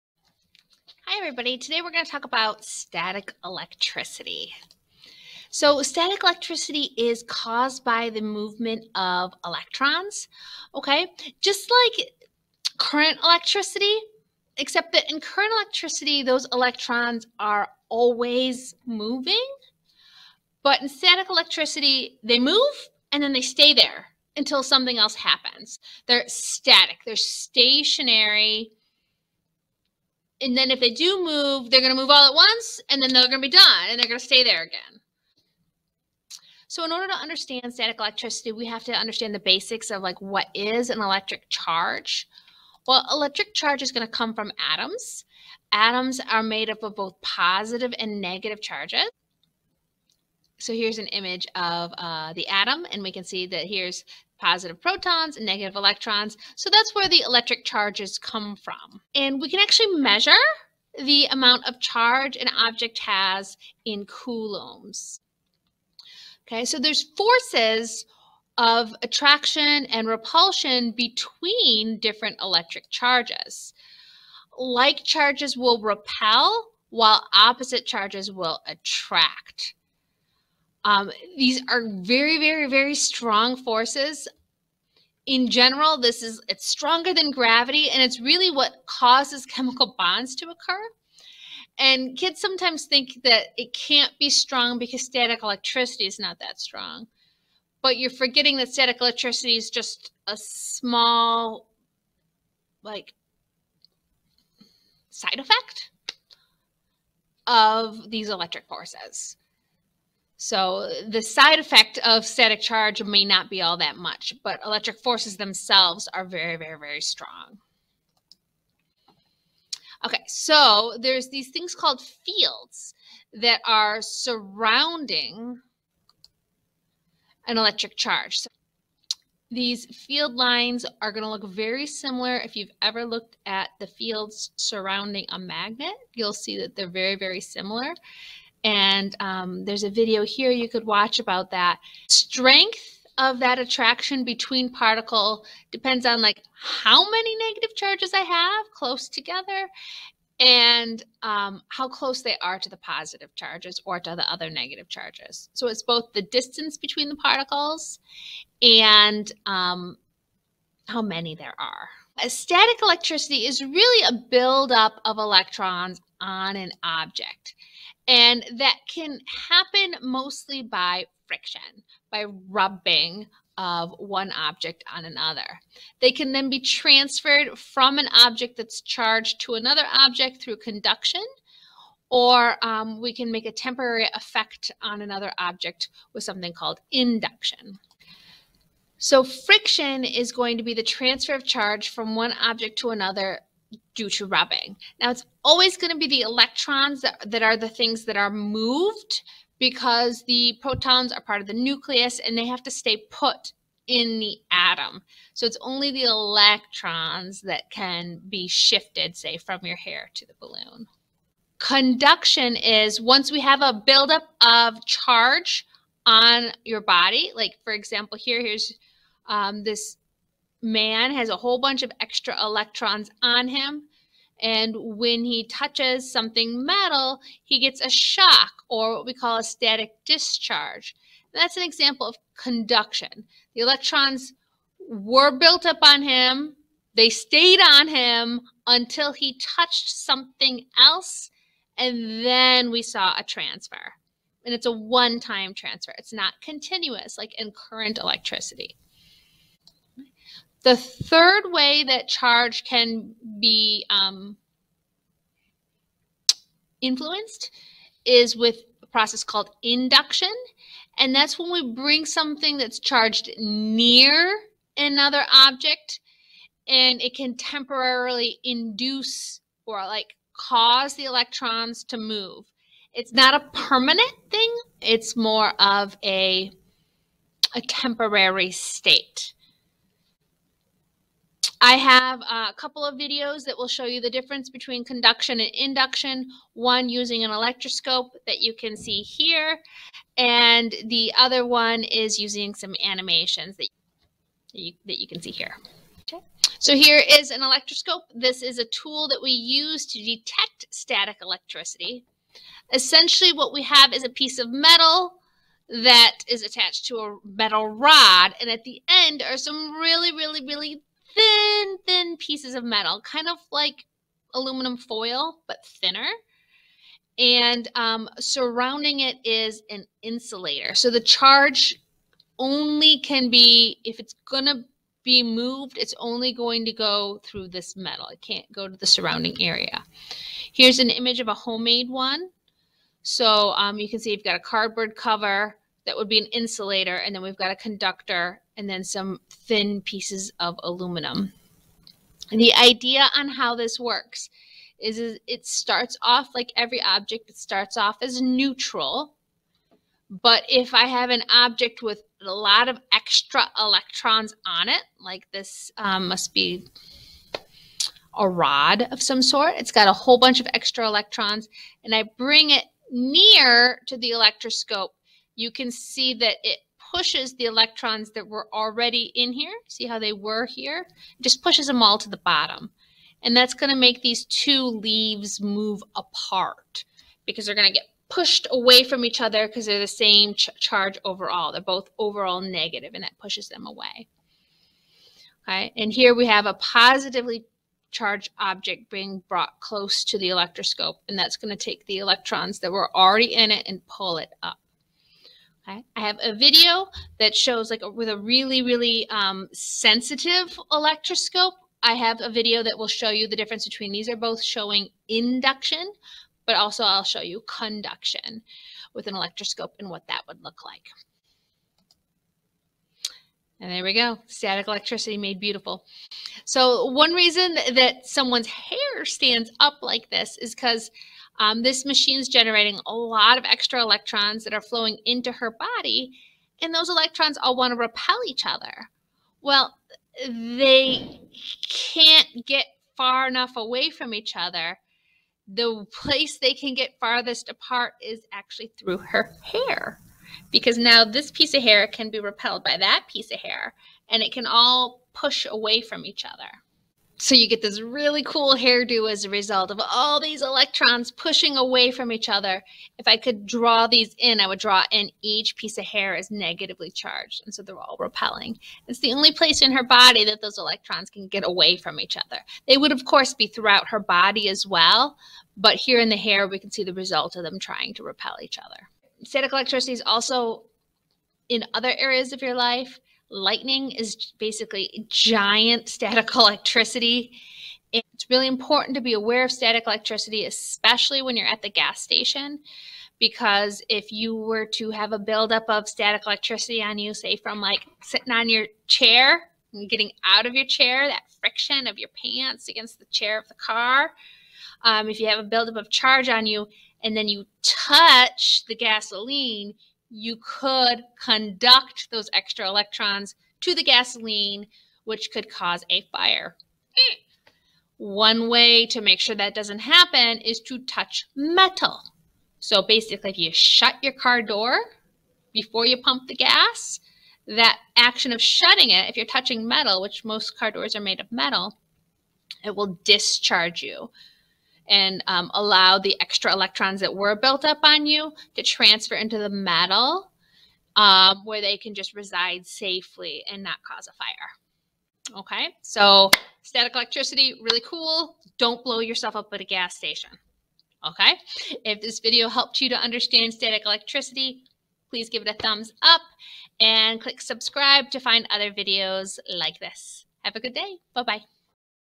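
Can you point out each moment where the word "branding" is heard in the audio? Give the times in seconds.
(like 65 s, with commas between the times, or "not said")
not said.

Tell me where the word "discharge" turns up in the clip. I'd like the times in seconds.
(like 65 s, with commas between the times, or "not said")
230 s, 523 s.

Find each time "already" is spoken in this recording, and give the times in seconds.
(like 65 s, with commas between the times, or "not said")
368 s, 392 s.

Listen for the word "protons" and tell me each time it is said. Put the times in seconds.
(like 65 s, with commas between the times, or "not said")
54 s, 200 s.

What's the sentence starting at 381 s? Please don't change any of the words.
They're both overall negative and that pushes them away.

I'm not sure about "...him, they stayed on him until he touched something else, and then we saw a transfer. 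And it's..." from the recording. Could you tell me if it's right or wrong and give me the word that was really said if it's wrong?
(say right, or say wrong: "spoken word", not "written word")
right.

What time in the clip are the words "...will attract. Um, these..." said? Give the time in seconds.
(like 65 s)
78 s.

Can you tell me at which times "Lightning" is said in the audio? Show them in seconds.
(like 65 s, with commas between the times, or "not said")
473 s.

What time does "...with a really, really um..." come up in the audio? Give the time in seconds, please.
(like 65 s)
397 s.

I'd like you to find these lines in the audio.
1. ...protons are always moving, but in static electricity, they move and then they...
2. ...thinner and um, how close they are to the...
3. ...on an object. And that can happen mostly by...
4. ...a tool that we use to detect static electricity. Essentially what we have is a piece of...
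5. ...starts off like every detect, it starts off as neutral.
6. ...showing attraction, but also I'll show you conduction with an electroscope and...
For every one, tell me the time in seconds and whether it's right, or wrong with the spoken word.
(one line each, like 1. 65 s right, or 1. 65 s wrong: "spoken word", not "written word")
1. 16 s wrong: "electrons", not "protons"
2. 149 s wrong: "together", not "thinner"
3. 166 s right
4. 298 s right
5. 345 s wrong: "object", not "detect"
6. 404 s wrong: "induction", not "attraction".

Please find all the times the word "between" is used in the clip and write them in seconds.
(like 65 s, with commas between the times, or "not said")
70 s, 144 s, 156 s, 284 s, 403 s.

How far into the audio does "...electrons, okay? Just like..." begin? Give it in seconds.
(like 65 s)
9 s.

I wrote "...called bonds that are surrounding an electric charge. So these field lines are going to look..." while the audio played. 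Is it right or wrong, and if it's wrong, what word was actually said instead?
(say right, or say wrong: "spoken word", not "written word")
wrong: "fields", not "bonds".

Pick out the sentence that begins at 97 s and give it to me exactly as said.
But you're forgetting that static electricity is just a small, like, side effect of these electric forces.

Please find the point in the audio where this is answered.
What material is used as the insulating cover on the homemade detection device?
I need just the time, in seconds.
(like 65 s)
334 s.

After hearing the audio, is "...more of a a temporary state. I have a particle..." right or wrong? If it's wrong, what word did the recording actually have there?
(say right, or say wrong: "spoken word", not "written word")
wrong: "couple", not "particle".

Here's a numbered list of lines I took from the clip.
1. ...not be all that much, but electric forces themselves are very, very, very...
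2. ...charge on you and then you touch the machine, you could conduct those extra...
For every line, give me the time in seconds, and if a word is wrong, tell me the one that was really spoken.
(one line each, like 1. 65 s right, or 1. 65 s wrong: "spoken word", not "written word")
1. 113 s right
2. 495 s wrong: "gasoline", not "machine".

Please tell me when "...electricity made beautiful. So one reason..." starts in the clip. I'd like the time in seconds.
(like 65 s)
414 s.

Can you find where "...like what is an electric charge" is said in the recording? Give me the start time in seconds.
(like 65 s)
40 s.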